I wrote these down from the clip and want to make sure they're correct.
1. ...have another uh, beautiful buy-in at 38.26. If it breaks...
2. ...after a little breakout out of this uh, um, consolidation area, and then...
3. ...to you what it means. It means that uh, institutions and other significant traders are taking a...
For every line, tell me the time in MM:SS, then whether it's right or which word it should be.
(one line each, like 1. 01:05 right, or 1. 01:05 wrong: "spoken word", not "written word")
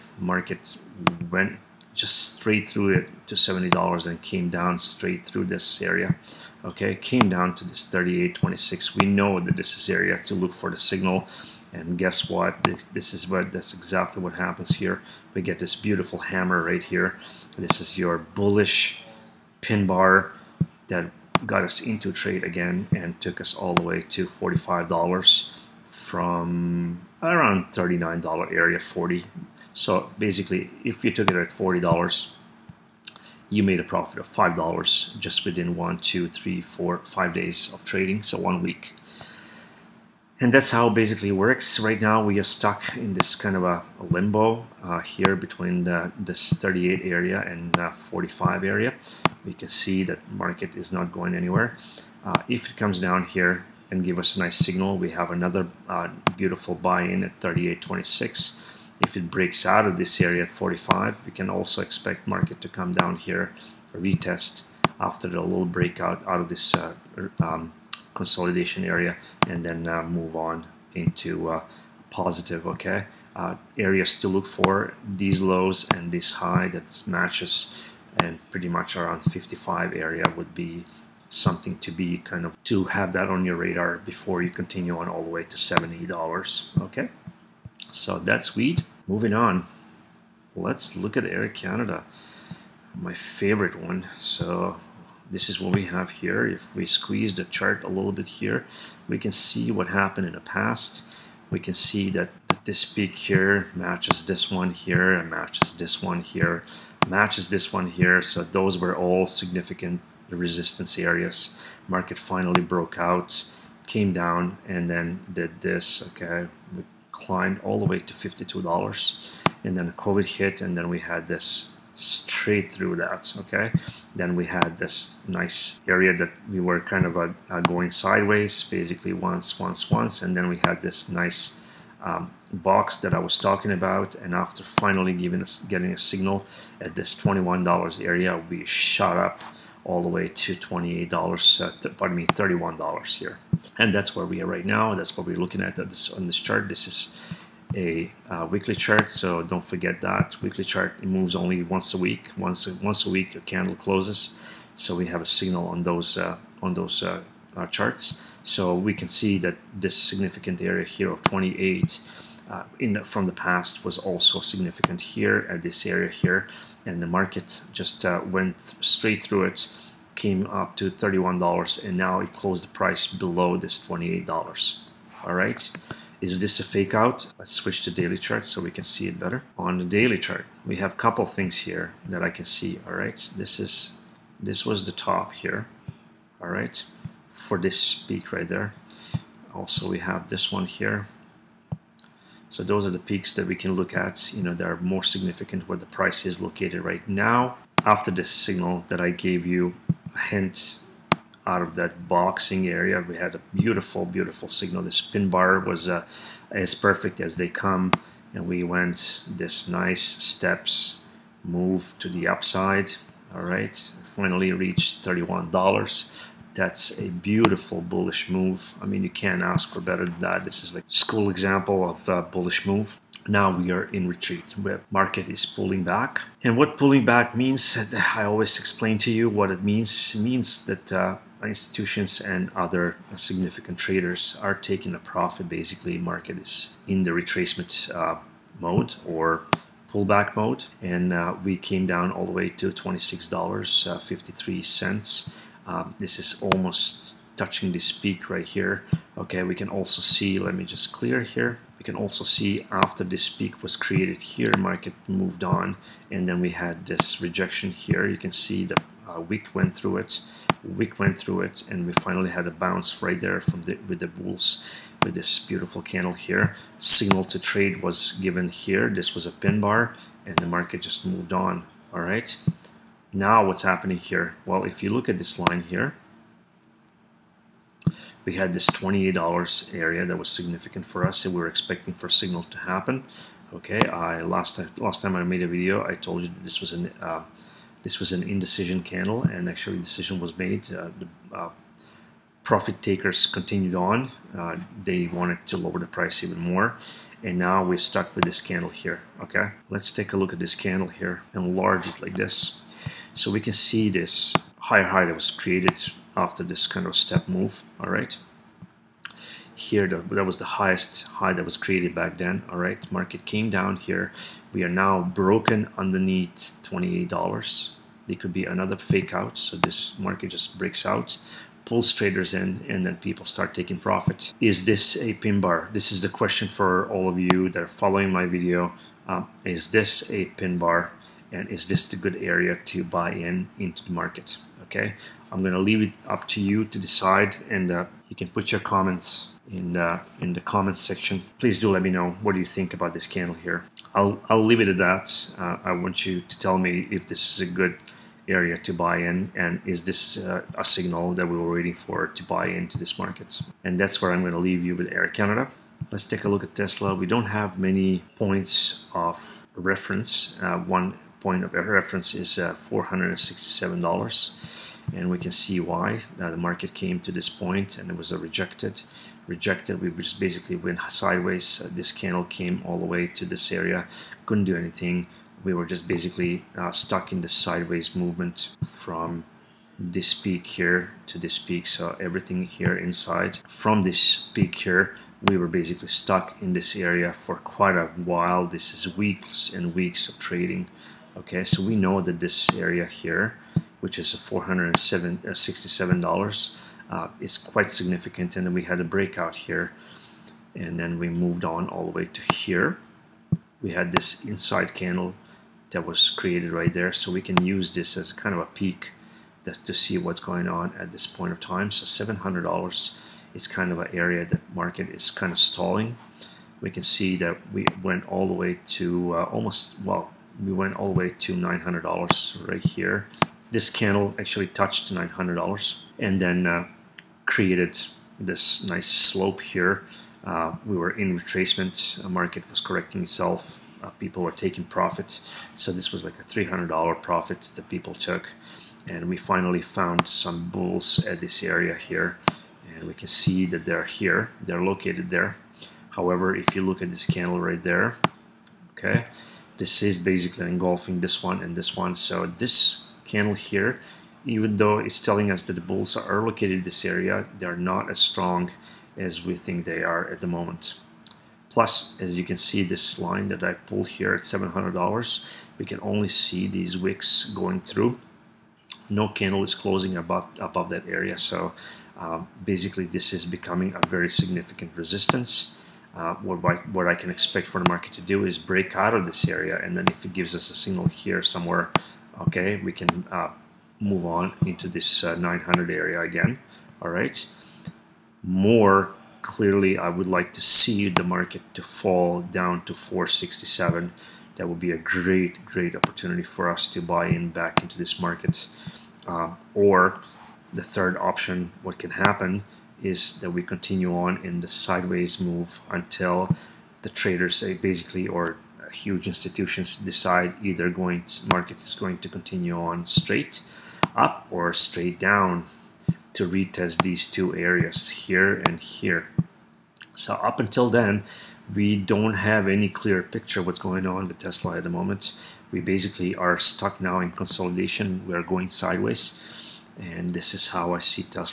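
1. 00:55 right
2. 01:05 right
3. 03:48 right.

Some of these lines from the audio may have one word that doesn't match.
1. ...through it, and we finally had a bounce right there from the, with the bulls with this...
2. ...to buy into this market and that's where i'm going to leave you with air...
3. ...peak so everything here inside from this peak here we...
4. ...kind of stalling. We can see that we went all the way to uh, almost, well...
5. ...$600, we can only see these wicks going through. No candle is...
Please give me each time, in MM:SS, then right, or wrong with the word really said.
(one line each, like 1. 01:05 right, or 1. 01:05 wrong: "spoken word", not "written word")
1. 04:21 right
2. 05:52 right
3. 06:21 right
4. 06:55 right
5. 07:44 wrong: "700", not "600".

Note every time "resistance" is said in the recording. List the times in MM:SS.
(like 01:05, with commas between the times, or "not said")
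01:50, 07:54.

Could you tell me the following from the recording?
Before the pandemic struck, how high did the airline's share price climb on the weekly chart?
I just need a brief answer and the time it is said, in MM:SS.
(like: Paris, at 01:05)
$52, at 01:58.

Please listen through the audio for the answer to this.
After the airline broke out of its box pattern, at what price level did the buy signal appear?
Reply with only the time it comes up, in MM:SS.
02:17.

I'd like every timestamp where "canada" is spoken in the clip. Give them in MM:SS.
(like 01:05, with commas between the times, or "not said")
01:31, 05:55.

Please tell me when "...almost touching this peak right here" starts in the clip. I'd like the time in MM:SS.
04:06.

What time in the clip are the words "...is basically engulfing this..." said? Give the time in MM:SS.
07:29.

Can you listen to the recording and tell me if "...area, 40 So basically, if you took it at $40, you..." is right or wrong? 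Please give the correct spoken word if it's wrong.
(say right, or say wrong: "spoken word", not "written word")
right.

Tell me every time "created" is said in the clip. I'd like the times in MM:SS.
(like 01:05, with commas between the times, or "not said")
04:13, 05:05, 05:11, 06:46, 07:07.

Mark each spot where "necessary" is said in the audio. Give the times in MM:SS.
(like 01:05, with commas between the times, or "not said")
not said.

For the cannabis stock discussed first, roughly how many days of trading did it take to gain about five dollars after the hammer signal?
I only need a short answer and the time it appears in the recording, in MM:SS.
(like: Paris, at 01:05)
5 days, at 00:37.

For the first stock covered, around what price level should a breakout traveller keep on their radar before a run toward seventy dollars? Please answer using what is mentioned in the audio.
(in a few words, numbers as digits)
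55.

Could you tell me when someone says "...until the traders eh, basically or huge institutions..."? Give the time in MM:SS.
08:25.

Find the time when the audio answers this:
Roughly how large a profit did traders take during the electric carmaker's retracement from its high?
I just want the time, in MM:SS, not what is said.
07:16.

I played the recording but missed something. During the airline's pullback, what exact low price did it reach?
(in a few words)
$26.53.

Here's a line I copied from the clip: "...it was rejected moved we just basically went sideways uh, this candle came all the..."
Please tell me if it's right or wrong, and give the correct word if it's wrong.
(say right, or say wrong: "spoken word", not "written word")
wrong: "rejected", not "moved".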